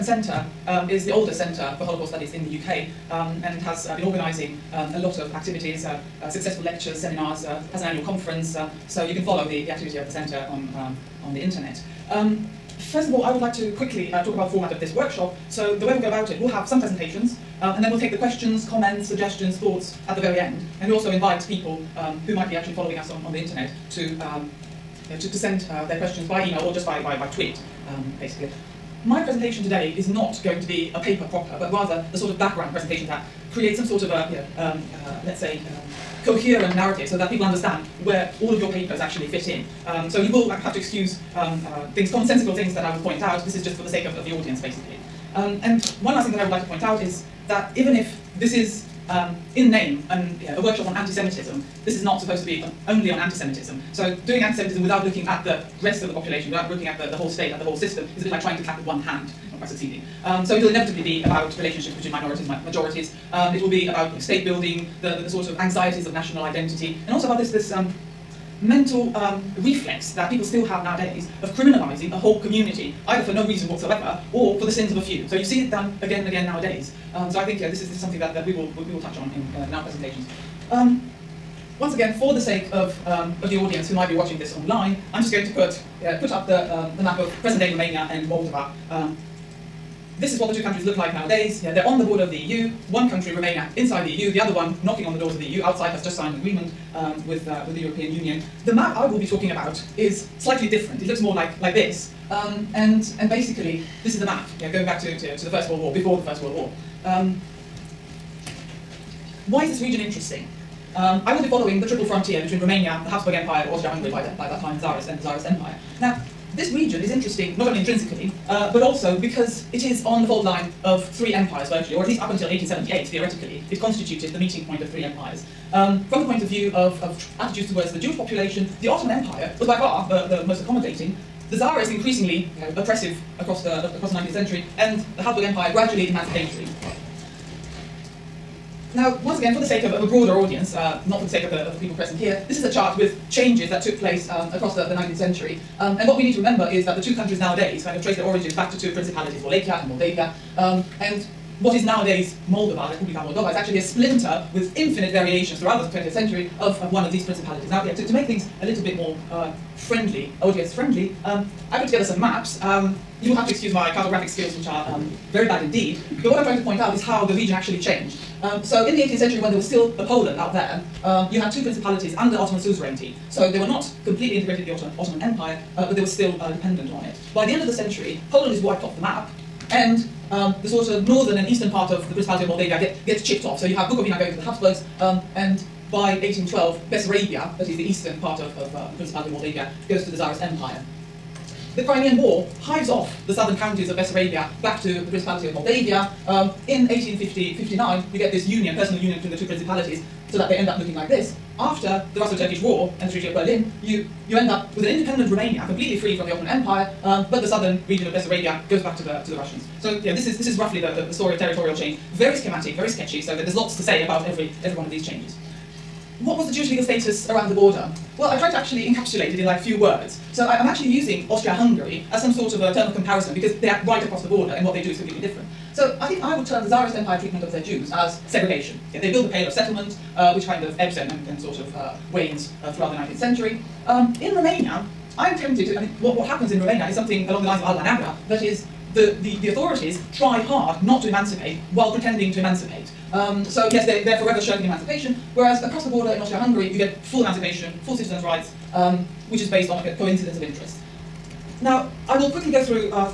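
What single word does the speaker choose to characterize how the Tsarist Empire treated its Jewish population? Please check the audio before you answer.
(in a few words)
Segregation.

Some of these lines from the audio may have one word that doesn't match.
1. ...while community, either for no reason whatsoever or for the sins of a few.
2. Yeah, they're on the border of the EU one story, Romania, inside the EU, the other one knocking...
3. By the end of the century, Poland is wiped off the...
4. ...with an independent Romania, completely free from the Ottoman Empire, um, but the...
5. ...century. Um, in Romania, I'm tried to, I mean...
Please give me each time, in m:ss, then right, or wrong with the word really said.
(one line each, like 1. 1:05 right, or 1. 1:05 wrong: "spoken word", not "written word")
1. 1:12 wrong: "whole", not "while"
2. 1:31 wrong: "country", not "story"
3. 2:57 right
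4. 3:24 right
5. 3:53 wrong: "tempted", not "tried".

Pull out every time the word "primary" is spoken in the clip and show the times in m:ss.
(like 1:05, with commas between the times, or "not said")
not said.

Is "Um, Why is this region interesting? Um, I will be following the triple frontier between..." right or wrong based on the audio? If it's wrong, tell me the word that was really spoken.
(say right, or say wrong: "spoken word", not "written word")
right.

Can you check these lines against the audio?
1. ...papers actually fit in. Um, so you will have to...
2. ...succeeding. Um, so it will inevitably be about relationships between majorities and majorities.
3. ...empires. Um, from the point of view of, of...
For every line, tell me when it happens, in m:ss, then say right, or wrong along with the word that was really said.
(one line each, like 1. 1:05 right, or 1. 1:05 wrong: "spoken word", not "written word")
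1. 0:38 right
2. 0:59 wrong: "minorities", not "majorities"
3. 2:05 right.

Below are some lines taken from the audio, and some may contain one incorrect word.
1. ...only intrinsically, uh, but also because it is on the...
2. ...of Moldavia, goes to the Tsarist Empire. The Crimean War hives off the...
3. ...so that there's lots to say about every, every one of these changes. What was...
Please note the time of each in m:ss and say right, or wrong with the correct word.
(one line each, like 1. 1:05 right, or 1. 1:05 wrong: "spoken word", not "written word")
1. 1:57 right
2. 3:09 right
3. 3:33 right.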